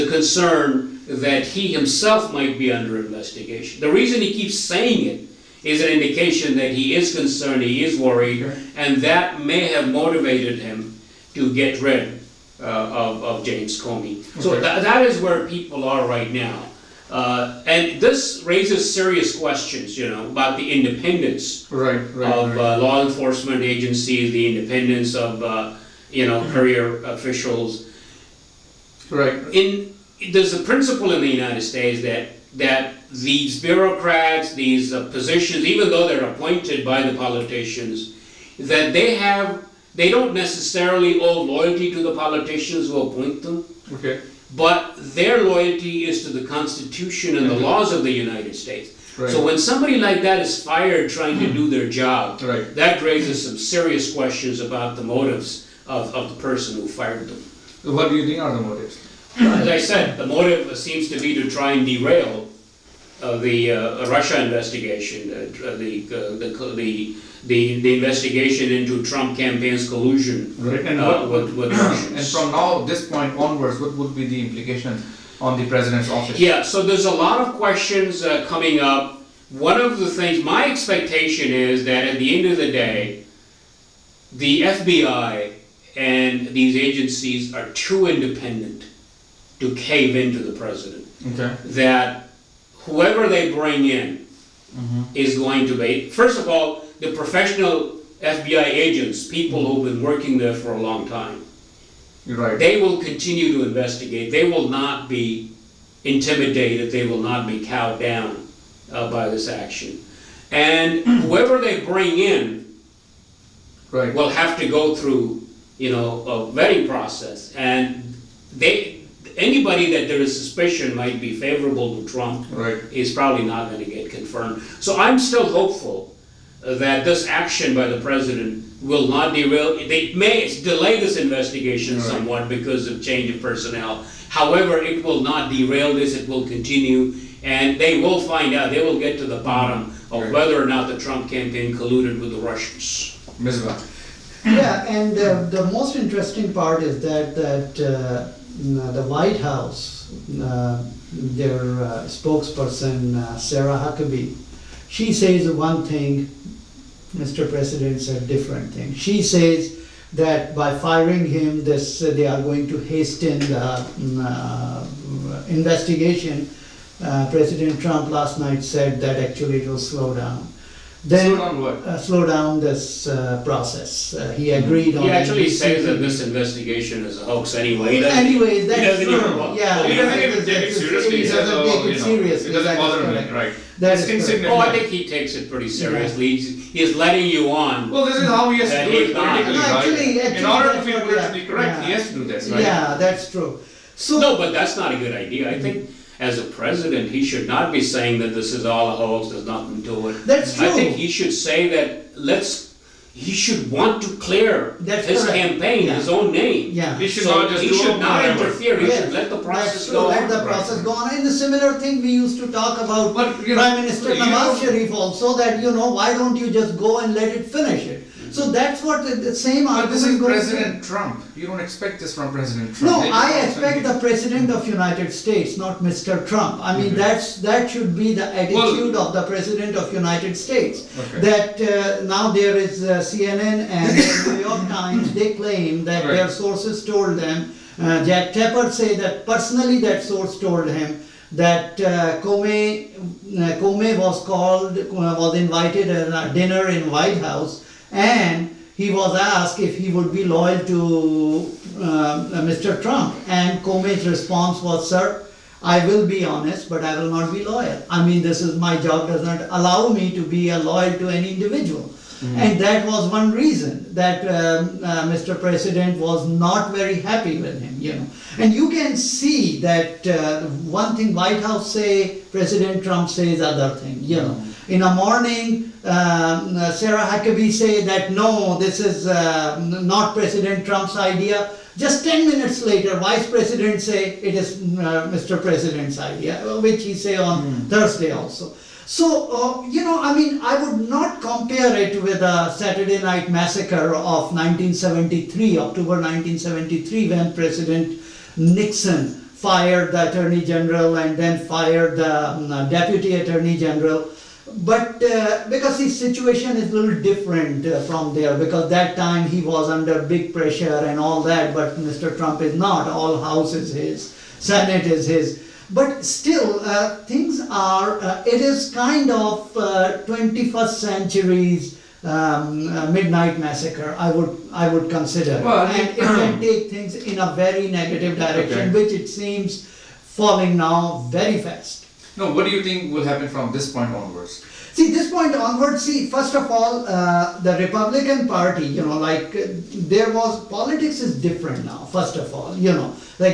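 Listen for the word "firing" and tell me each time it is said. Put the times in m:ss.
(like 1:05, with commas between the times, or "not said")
2:40.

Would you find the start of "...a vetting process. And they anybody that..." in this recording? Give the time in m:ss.
1:56.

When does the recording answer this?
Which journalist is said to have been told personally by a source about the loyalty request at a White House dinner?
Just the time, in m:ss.
3:58.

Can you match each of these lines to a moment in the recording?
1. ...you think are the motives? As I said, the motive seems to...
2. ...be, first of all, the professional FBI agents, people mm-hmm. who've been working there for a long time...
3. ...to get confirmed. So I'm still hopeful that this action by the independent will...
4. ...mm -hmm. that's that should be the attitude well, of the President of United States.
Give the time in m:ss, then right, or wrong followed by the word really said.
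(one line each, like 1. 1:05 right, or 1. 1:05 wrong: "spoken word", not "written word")
1. 0:58 right
2. 1:35 right
3. 2:03 wrong: "president", not "independent"
4. 3:46 right.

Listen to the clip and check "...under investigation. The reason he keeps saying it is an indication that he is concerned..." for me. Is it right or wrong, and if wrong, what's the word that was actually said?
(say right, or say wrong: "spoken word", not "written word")
right.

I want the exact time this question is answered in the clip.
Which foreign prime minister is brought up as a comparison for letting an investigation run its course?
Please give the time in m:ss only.
3:34.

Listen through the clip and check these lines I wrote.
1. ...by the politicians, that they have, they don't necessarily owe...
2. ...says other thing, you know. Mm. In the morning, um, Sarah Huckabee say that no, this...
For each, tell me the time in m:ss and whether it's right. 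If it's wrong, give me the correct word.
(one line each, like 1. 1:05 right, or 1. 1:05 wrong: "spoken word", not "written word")
1. 0:36 right
2. 4:33 right.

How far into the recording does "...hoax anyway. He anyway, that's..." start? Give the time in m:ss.
2:57.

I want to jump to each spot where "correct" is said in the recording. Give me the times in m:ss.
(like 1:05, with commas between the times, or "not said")
3:11, 3:25.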